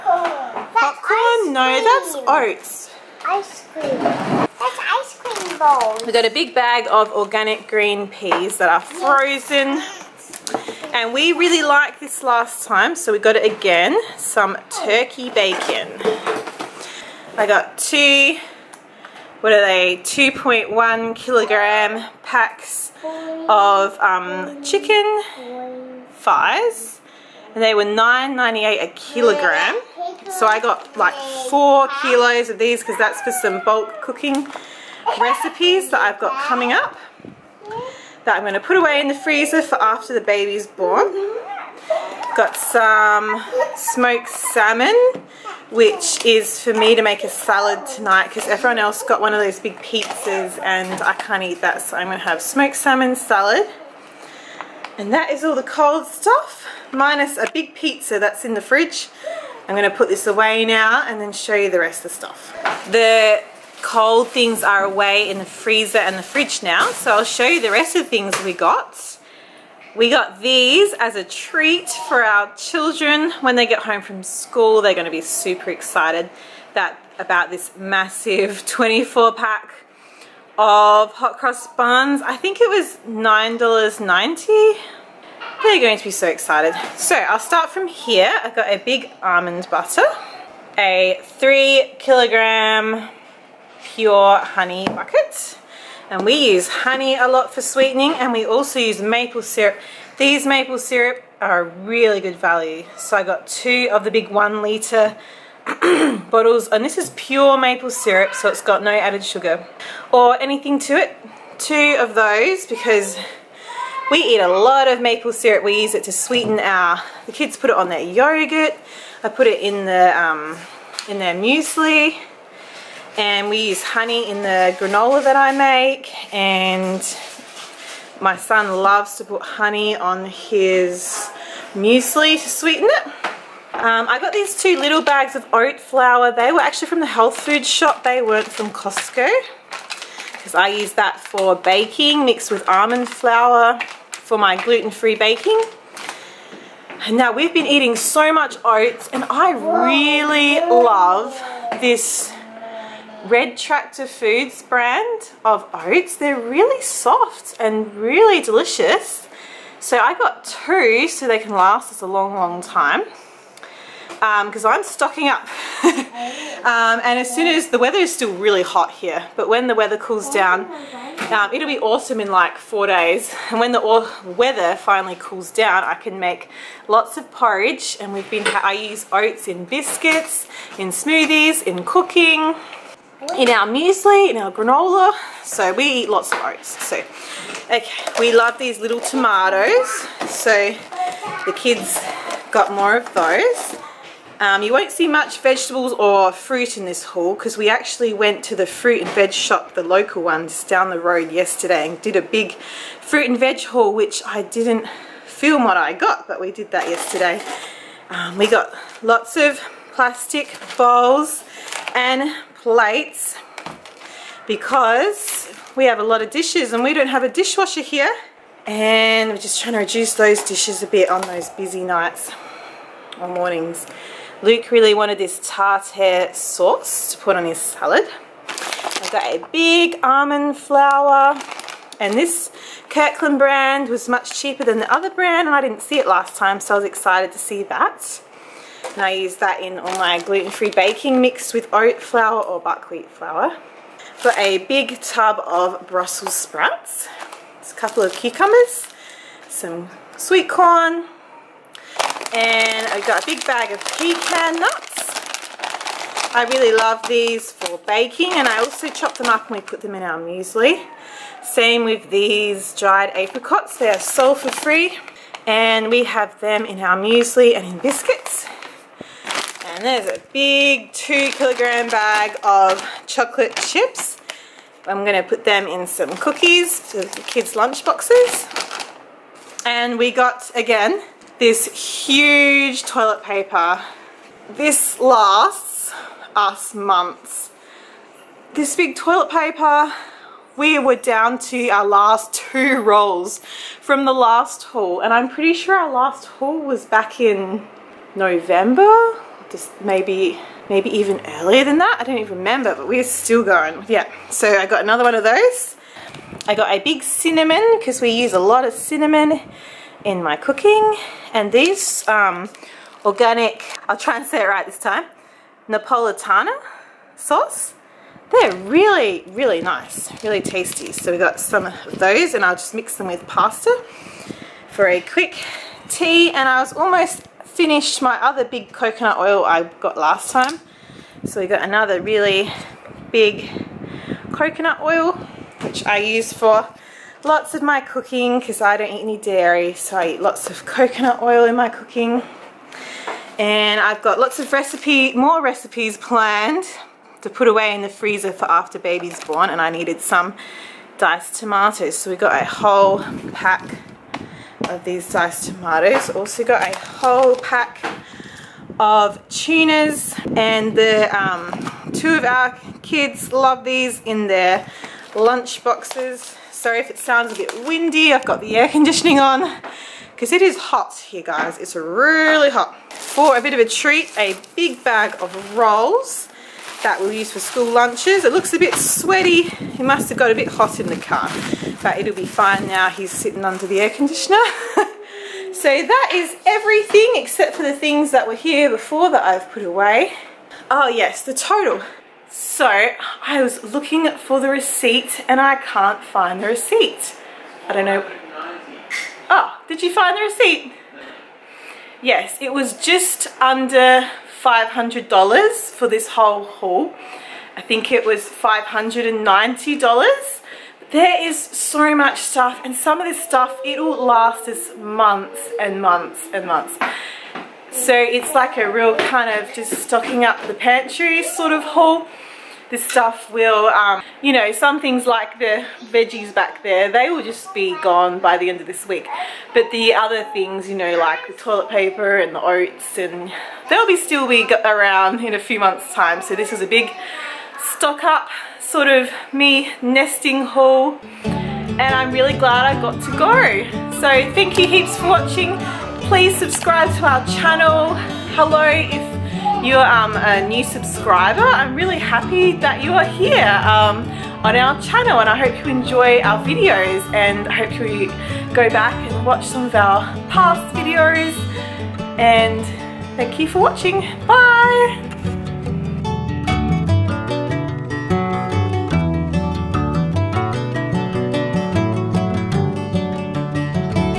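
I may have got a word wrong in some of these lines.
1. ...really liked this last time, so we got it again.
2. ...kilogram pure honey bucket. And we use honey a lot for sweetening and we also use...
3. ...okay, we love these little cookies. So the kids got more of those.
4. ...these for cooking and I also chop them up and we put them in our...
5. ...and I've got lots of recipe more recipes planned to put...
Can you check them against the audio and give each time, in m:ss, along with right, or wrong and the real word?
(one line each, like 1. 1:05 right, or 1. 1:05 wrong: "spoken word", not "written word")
1. 0:11 right
2. 1:31 right
3. 3:07 wrong: "tomatoes", not "cookies"
4. 4:17 wrong: "baking", not "cooking"
5. 5:43 right.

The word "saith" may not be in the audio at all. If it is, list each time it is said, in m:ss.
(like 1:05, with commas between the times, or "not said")
not said.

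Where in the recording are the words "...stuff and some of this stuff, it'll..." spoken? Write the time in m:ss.
6:52.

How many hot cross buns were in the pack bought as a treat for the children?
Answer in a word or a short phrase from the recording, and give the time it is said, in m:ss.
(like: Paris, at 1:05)
24, at 1:18.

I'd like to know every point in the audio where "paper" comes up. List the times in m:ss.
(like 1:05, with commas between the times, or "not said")
4:43, 4:49, 7:11.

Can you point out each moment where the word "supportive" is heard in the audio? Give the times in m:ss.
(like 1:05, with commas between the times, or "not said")
not said.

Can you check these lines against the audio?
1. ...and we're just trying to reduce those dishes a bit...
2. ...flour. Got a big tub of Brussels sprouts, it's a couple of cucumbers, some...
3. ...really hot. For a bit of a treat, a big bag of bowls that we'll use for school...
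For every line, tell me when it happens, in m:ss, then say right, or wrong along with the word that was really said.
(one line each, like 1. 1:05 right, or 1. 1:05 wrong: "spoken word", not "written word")
1. 3:38 right
2. 4:03 right
3. 6:11 wrong: "rolls", not "bowls".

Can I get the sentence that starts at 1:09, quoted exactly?
We got these as a treat for our children.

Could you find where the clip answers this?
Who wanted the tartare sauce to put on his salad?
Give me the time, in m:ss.
3:44.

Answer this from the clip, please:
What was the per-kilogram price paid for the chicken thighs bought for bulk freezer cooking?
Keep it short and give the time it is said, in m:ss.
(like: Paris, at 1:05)
$9.98, at 0:27.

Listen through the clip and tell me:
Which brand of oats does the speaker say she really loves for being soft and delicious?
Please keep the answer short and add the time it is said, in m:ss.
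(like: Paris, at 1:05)
Red Tractor Foods, at 2:33.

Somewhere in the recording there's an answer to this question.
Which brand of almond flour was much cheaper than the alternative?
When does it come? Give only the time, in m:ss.
3:52.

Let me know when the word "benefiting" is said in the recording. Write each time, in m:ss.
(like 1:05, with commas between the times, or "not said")
not said.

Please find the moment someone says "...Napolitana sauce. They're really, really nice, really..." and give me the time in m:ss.
5:15.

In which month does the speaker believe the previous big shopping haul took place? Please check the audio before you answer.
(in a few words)
November.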